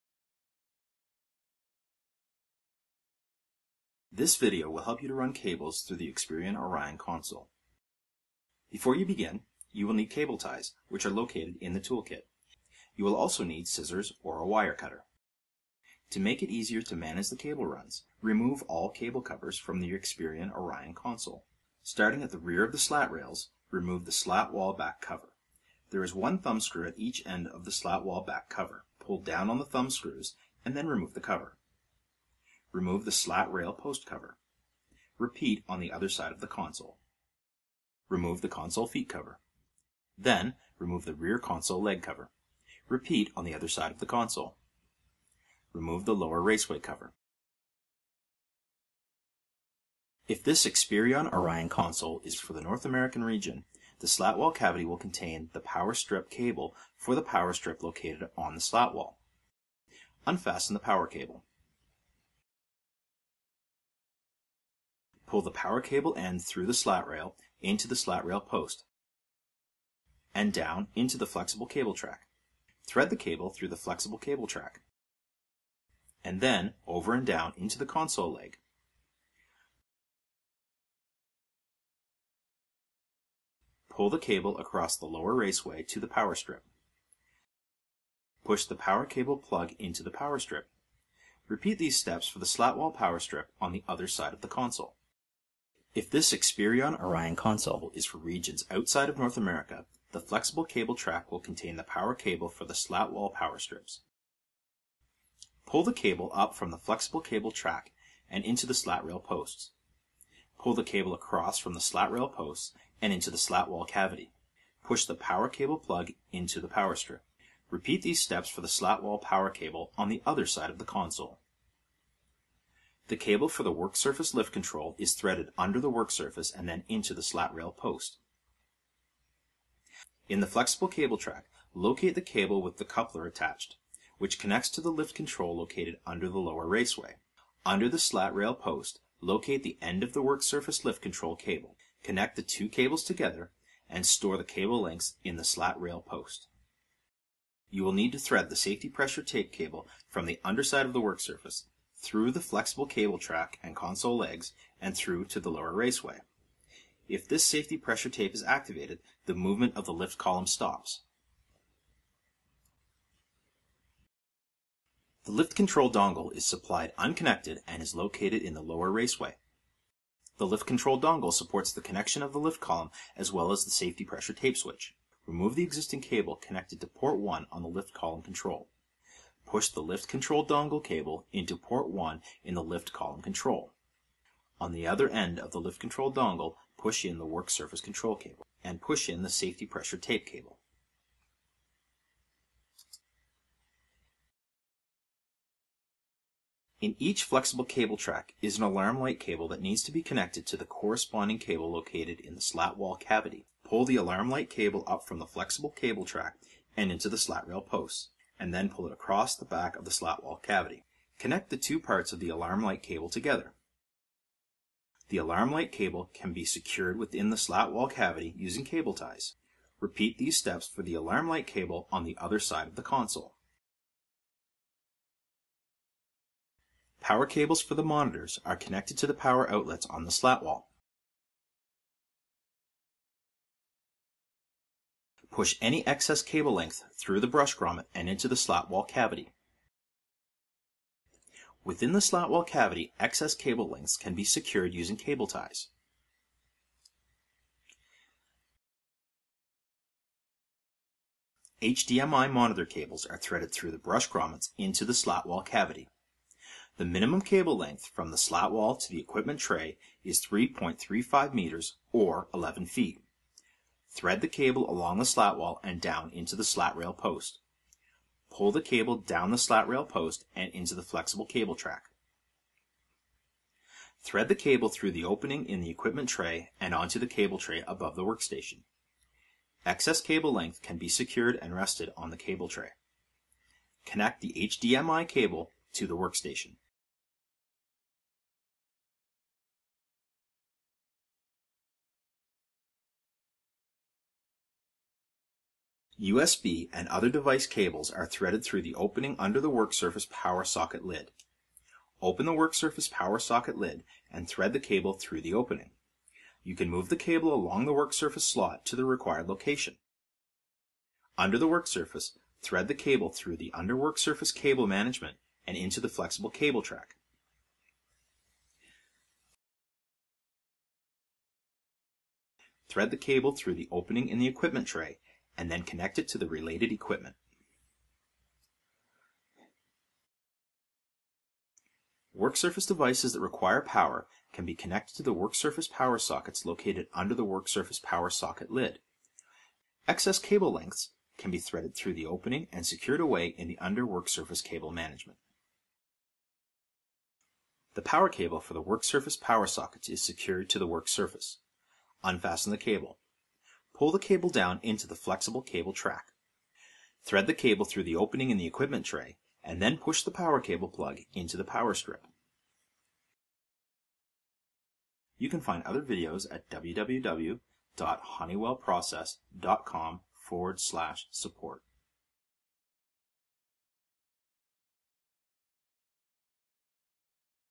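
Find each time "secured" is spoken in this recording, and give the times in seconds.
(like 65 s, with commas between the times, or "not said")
216 s, 244 s, 280 s, 342 s, 350 s.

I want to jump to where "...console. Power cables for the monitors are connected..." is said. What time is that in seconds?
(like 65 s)
222 s.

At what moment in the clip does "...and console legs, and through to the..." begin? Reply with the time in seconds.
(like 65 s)
153 s.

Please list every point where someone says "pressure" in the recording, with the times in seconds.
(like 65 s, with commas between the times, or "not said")
148 s, 157 s, 174 s, 189 s.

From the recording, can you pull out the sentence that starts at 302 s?
Open the work surface power socket lid and thread the cable through the opening.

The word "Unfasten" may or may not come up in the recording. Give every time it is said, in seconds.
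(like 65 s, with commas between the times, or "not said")
60 s, 352 s.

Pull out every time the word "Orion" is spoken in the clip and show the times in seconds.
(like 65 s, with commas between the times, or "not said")
6 s, 20 s, 51 s, 97 s.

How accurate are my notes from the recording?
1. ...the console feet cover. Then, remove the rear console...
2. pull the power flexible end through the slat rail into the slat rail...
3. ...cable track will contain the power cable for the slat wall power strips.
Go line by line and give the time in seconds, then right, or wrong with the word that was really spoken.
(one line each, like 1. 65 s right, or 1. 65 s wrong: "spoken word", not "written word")
1. 38 s right
2. 65 s wrong: "cable", not "flexible"
3. 100 s right.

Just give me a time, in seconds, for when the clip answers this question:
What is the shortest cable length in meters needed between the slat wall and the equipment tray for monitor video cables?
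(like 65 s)
260 s.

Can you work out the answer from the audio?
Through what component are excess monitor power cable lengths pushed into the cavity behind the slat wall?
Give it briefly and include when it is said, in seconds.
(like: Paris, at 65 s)
brush grommet, at 237 s.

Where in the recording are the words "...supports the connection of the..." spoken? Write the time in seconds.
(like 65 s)
171 s.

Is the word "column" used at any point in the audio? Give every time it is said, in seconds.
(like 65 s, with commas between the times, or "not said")
160 s, 172 s, 177 s, 182 s.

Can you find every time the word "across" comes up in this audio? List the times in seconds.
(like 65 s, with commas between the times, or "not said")
84 s, 111 s, 208 s.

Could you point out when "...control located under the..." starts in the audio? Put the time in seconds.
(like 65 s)
135 s.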